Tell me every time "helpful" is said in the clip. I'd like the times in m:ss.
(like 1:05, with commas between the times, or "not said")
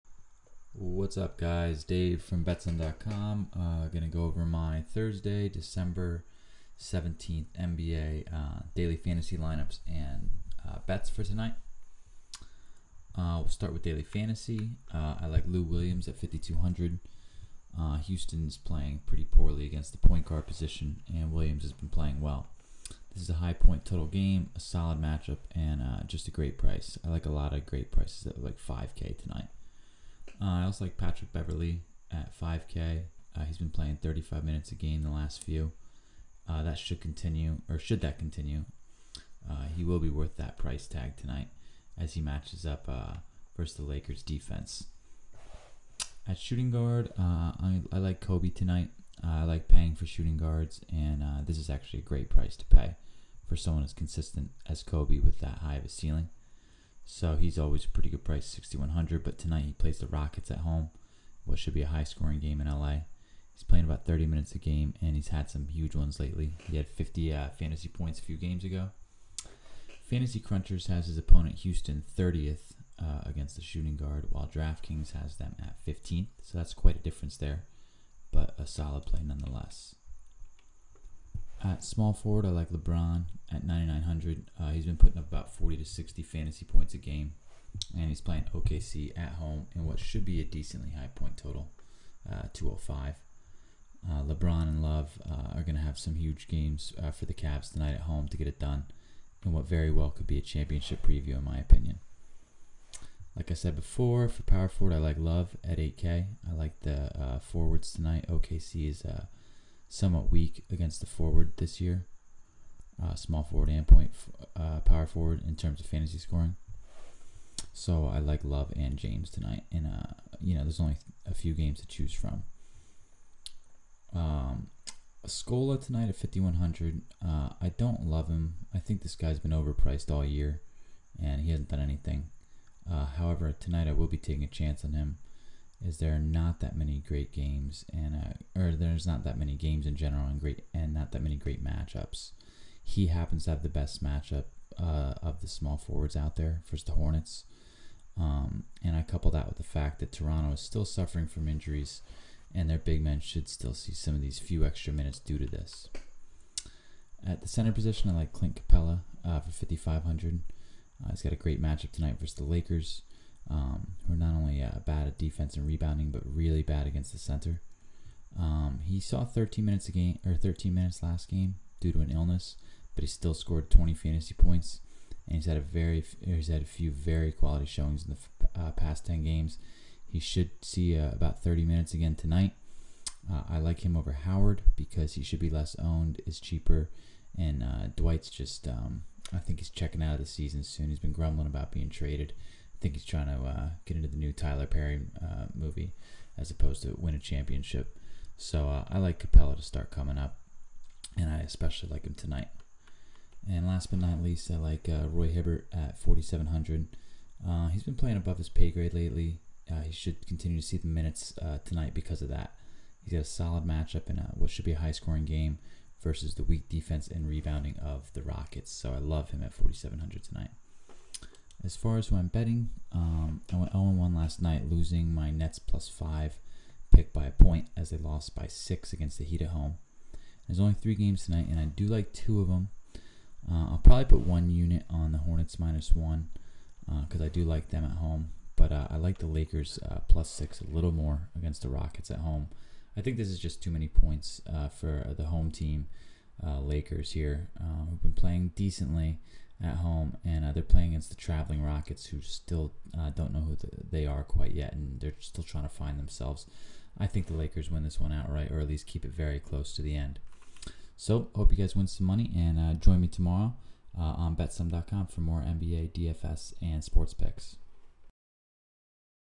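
not said.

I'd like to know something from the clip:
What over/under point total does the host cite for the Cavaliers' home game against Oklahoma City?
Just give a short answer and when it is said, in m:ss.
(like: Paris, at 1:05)
205, at 1:32.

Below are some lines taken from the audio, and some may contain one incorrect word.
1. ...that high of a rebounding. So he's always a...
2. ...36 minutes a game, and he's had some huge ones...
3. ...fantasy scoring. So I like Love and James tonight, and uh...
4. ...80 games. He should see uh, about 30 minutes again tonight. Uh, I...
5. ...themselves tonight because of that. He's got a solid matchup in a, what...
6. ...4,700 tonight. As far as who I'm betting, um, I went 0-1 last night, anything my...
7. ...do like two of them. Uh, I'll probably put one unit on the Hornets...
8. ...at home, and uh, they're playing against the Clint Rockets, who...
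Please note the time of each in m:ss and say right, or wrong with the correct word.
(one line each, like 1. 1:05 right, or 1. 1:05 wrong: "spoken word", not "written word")
1. 0:55 wrong: "ceiling", not "rebounding"
2. 1:04 wrong: "30", not "36"
3. 1:55 right
4. 2:59 wrong: "10", not "80"
5. 3:30 wrong: "minutes", not "themselves"
6. 3:39 wrong: "losing", not "anything"
7. 3:51 right
8. 4:09 wrong: "Traveling", not "Clint".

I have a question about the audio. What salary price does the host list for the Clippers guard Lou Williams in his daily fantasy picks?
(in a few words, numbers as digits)
5,200.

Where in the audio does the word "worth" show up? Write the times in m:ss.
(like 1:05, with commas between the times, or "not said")
0:40.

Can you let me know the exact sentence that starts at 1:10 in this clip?
Fantasy Crunchers has his opponent Houston 30th uh, against the shooting guard, while DraftKings has them at 15th.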